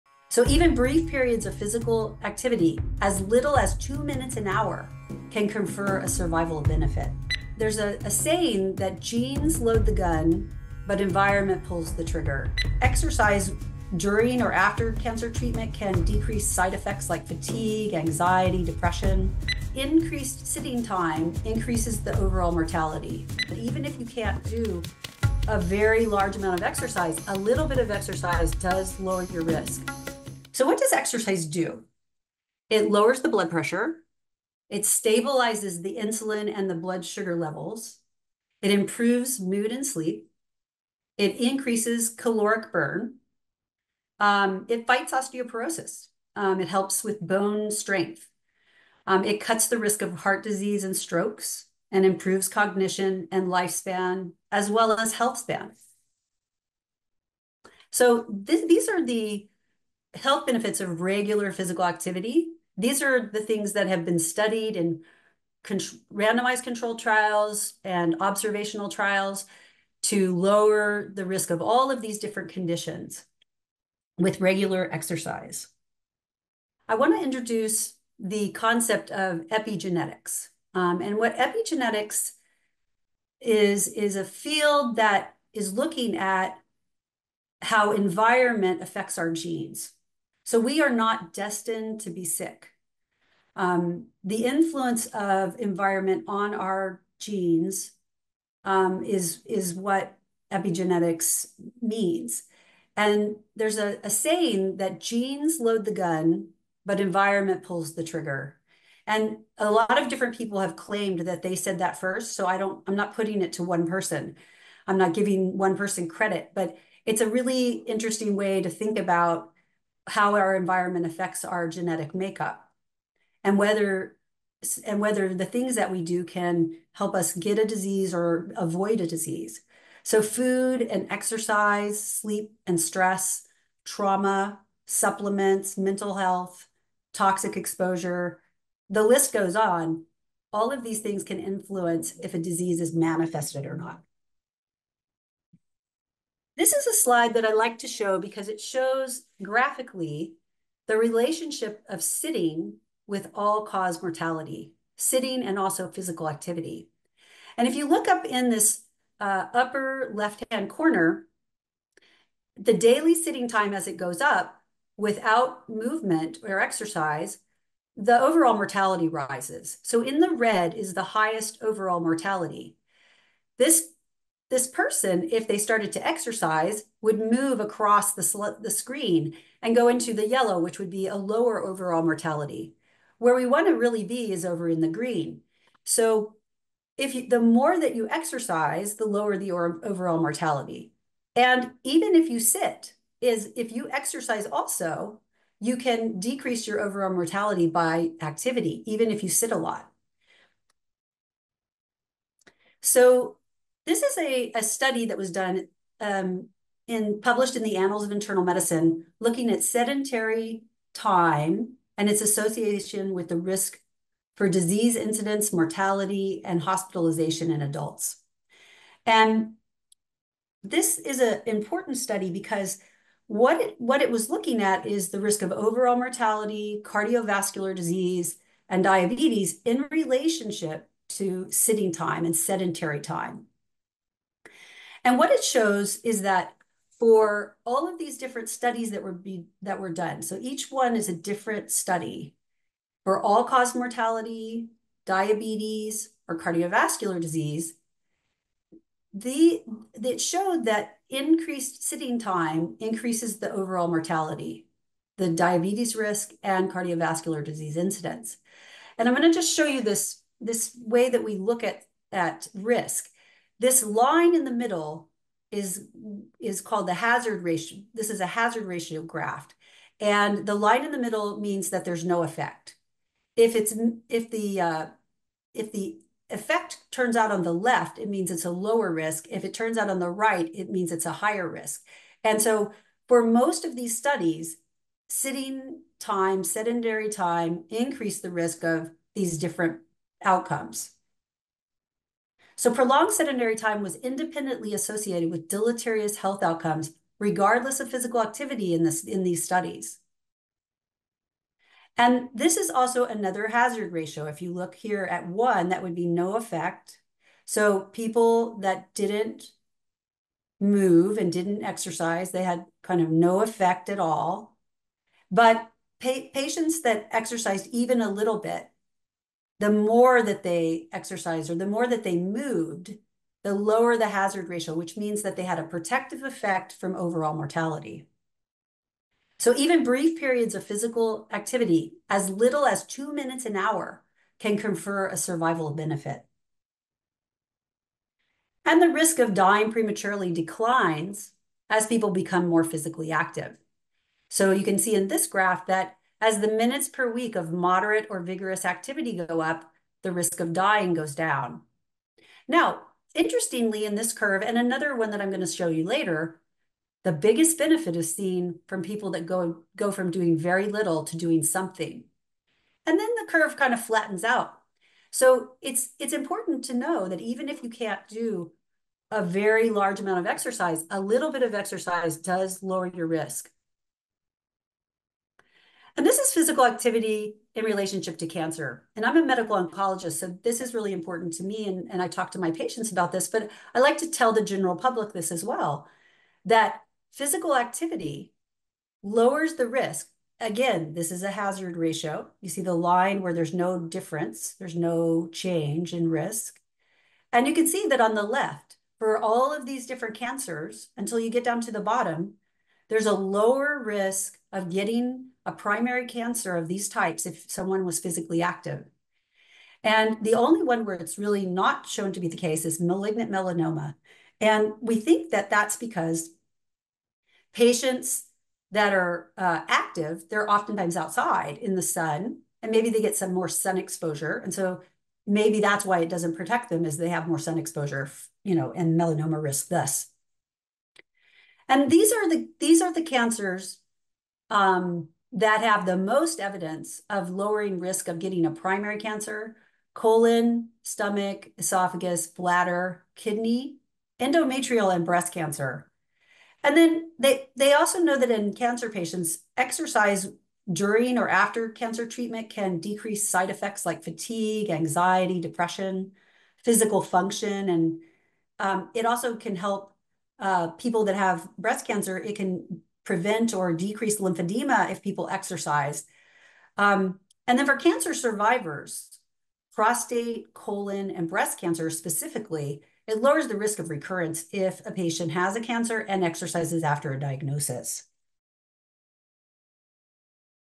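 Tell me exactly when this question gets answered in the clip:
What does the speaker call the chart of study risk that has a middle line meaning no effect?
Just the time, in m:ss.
4:28.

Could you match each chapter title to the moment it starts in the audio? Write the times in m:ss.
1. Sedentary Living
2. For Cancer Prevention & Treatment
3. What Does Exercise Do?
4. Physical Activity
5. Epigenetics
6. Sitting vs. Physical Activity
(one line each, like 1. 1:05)
1. 3:22
2. 7:10
3. 0:30
4. 5:37
5. 1:16
6. 2:26.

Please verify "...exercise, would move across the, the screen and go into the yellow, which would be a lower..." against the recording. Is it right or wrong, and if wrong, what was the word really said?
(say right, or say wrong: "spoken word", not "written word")
right.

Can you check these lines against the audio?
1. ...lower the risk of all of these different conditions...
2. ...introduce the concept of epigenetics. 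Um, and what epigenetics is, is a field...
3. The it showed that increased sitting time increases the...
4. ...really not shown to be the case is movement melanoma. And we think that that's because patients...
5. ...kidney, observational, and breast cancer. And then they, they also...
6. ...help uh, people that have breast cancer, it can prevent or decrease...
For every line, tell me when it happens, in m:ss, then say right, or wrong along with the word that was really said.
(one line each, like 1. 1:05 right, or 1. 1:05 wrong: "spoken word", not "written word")
1. 1:10 right
2. 1:17 right
3. 4:09 right
4. 6:51 wrong: "malignant", not "movement"
5. 7:23 wrong: "endometrial", not "observational"
6. 7:39 right.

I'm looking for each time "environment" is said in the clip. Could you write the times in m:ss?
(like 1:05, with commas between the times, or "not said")
0:11, 1:27, 1:35, 1:46, 2:00.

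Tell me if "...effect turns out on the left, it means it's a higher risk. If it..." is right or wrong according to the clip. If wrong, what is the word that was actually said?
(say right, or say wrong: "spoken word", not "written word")
wrong: "lower", not "higher".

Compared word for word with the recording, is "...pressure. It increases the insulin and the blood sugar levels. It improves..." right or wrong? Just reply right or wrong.
wrong.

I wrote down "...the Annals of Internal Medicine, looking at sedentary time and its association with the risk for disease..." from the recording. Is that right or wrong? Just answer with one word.
right.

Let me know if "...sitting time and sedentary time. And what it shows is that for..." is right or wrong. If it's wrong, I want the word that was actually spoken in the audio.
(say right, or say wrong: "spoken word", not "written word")
right.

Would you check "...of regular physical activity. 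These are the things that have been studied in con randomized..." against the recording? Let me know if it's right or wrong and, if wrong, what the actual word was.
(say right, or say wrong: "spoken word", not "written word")
right.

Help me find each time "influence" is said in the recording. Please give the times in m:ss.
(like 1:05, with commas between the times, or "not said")
1:34, 2:21.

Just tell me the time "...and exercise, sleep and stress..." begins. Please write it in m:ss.
2:10.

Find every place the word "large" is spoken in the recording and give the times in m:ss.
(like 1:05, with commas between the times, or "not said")
0:26, 6:09.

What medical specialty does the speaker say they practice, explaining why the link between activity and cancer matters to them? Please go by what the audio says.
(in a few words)
Medical oncologist.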